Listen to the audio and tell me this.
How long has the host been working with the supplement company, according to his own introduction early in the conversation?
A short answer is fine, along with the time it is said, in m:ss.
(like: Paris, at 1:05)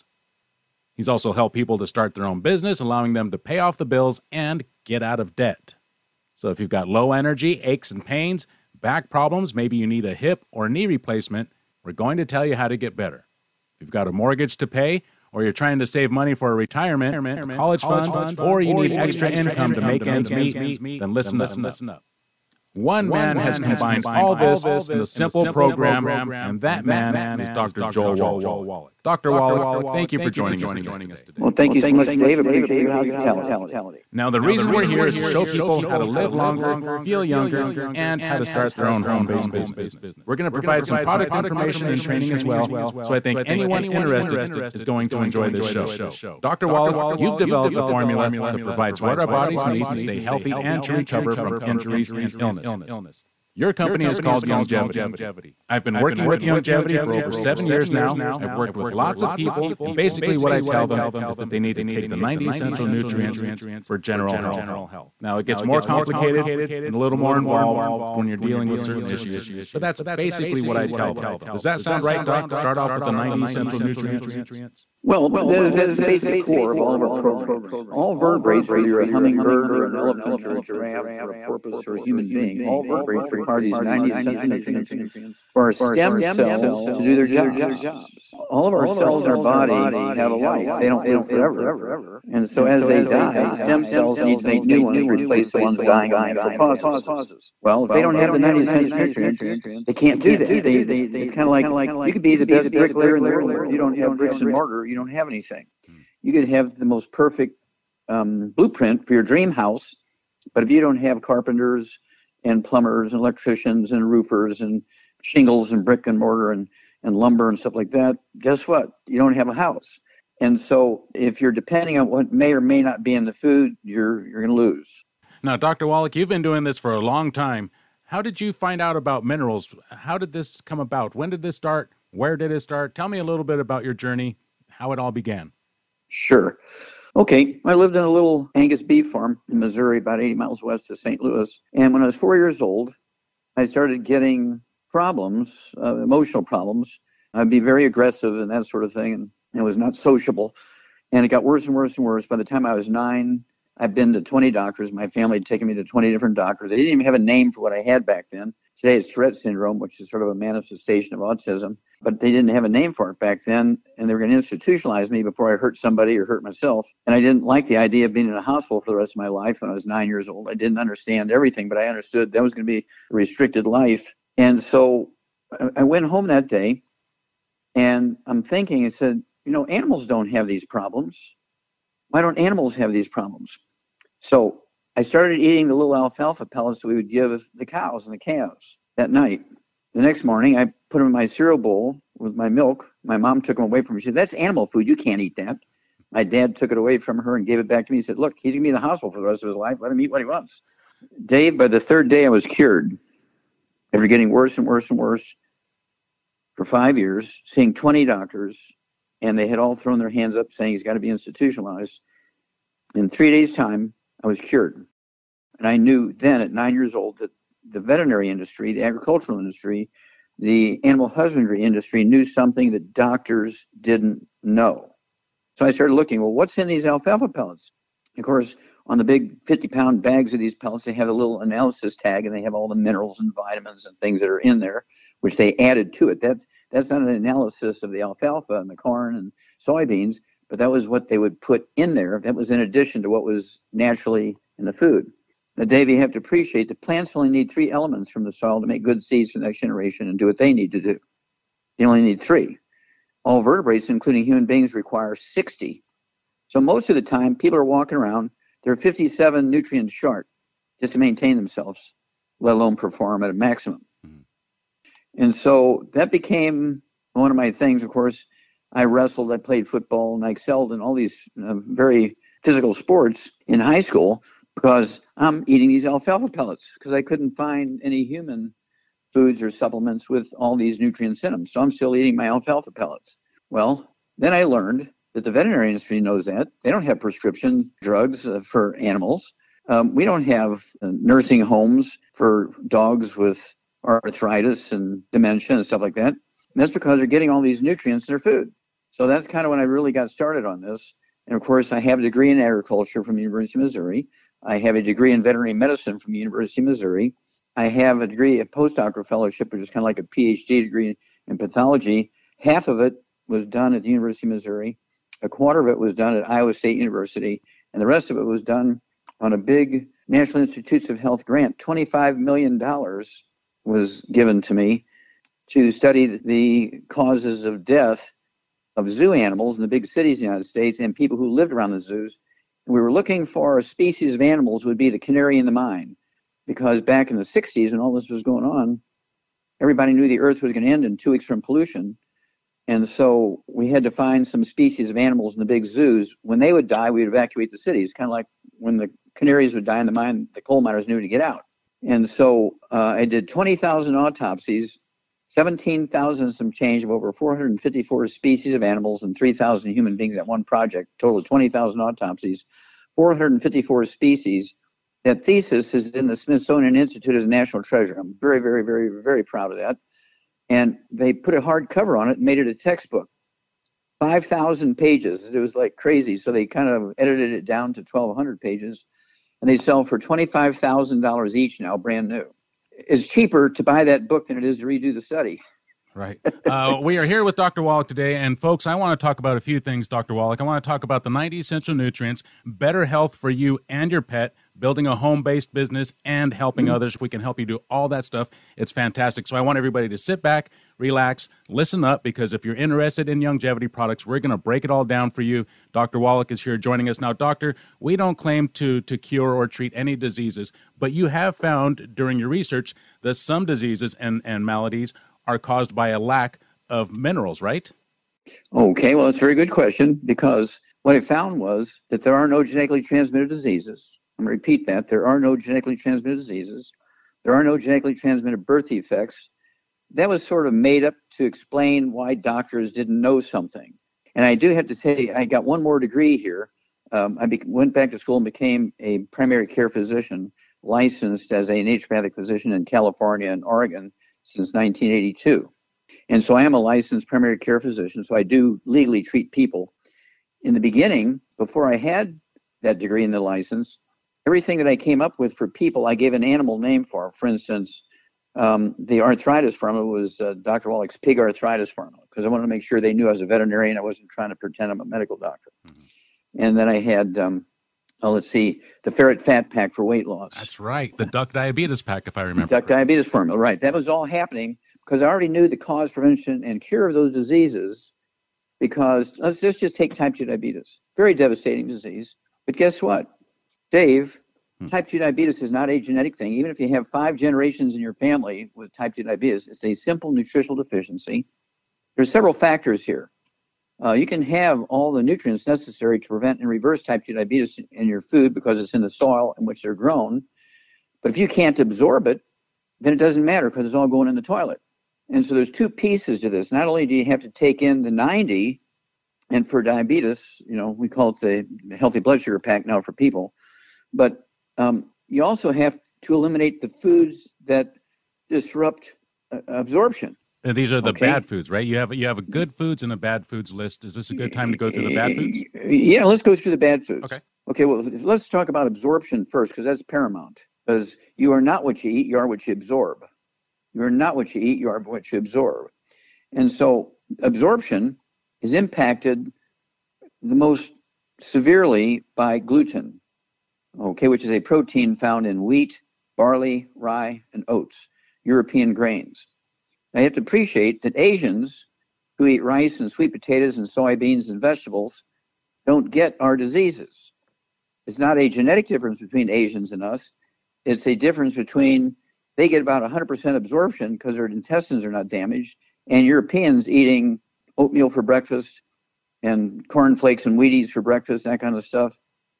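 over 7 years, at 0:57.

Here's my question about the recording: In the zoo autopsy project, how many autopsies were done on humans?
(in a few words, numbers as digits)
3,000.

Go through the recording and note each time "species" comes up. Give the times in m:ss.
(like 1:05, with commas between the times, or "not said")
5:33, 5:44, 5:58, 6:03.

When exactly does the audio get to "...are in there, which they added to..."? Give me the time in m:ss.
3:54.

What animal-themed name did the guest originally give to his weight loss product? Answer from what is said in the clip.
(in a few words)
ferret fat pack.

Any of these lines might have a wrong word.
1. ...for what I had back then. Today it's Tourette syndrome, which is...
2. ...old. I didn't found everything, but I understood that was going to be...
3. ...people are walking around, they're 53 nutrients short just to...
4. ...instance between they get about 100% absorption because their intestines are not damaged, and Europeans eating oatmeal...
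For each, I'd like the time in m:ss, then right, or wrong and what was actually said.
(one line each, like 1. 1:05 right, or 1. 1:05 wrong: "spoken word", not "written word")
1. 2:37 right
2. 2:50 wrong: "understand", not "found"
3. 4:17 wrong: "57", not "53"
4. 9:20 wrong: "difference", not "instance".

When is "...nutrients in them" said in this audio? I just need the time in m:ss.
4:40.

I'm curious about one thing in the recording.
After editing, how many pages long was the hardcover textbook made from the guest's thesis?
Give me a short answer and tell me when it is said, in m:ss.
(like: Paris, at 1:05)
1,200 pages, at 6:17.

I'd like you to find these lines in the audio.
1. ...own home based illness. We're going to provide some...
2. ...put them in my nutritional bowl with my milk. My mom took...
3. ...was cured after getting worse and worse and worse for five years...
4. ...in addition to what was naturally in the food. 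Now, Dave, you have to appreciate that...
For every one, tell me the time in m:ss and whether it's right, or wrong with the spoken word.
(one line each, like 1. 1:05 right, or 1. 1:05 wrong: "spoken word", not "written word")
1. 0:38 wrong: "business", not "illness"
2. 3:10 wrong: "cereal", not "nutritional"
3. 3:22 right
4. 4:02 right.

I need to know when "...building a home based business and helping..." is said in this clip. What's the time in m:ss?
6:34.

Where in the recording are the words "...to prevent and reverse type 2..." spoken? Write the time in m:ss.
8:15.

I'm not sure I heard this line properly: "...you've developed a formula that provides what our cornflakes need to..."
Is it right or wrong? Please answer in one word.
wrong.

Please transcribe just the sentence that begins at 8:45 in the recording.
Yeah, let's go through the bad foods.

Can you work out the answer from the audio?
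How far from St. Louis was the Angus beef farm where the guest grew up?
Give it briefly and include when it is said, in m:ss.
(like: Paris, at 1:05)
80 miles, at 2:20.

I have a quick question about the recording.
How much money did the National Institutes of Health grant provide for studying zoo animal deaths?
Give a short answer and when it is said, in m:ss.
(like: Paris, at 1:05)
$25 million, at 5:21.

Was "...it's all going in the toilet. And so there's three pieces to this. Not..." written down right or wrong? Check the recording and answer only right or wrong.
wrong.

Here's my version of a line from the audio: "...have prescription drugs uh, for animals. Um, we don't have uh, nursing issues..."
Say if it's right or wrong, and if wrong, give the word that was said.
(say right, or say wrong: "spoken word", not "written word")
wrong: "homes", not "issues".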